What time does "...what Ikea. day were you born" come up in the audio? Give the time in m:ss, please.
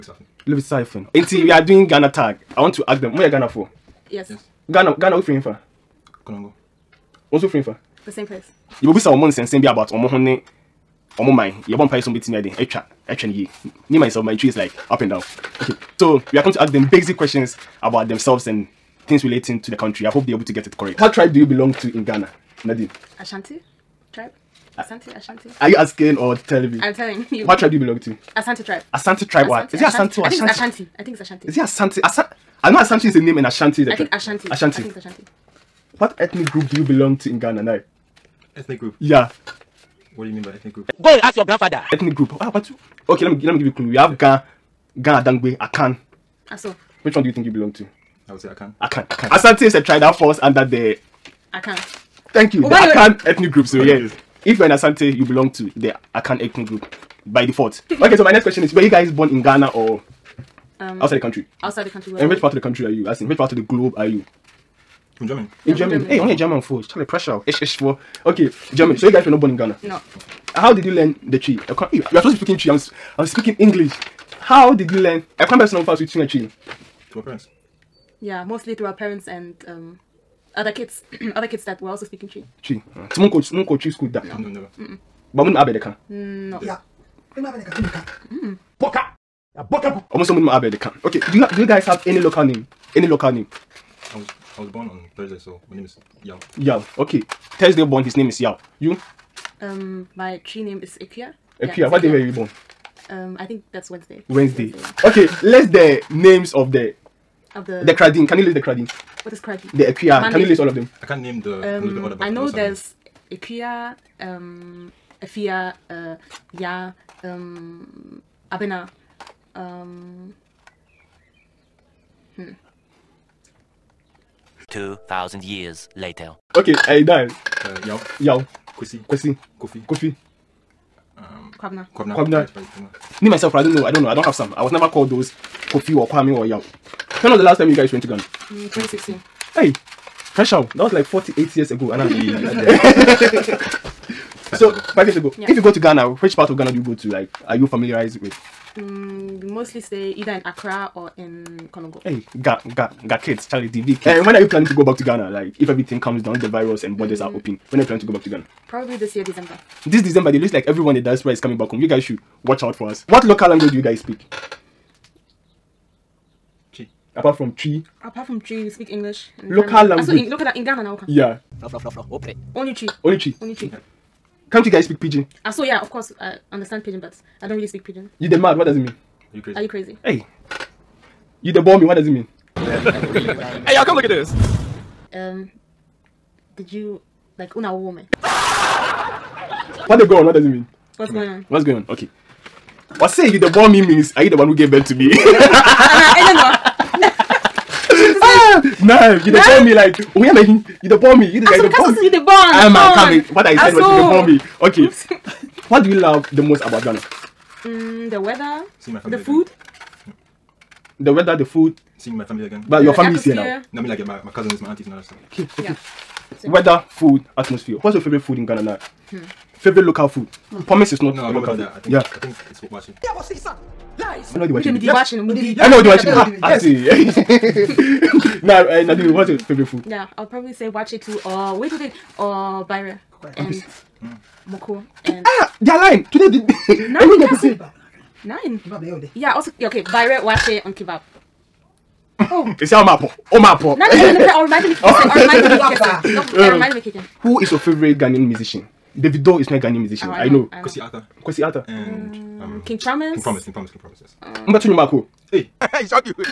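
1:41.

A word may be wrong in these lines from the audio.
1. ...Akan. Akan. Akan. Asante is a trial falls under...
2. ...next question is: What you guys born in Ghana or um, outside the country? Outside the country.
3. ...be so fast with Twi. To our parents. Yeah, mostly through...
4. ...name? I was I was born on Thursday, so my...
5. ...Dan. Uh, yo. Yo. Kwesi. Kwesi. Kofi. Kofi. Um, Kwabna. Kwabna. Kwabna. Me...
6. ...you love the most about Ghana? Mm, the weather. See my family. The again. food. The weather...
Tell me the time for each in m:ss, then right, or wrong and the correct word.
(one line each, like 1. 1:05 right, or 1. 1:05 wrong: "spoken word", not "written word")
1. 0:48 right
2. 0:58 wrong: "Were", not "What"
3. 1:15 right
4. 1:33 right
5. 2:07 right
6. 3:25 right.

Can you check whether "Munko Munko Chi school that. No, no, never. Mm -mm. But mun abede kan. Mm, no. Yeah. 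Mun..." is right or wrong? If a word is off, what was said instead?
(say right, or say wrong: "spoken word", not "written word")
right.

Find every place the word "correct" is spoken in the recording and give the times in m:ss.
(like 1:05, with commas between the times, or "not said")
0:20.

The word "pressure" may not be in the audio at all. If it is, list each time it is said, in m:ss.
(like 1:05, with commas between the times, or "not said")
1:07, 2:20.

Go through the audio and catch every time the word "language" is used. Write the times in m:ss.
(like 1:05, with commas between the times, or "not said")
2:43, 2:49.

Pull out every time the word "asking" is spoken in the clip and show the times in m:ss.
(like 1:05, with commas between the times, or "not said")
0:25.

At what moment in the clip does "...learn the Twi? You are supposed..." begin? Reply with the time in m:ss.
1:10.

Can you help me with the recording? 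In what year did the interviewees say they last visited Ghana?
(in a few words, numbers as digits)
2016.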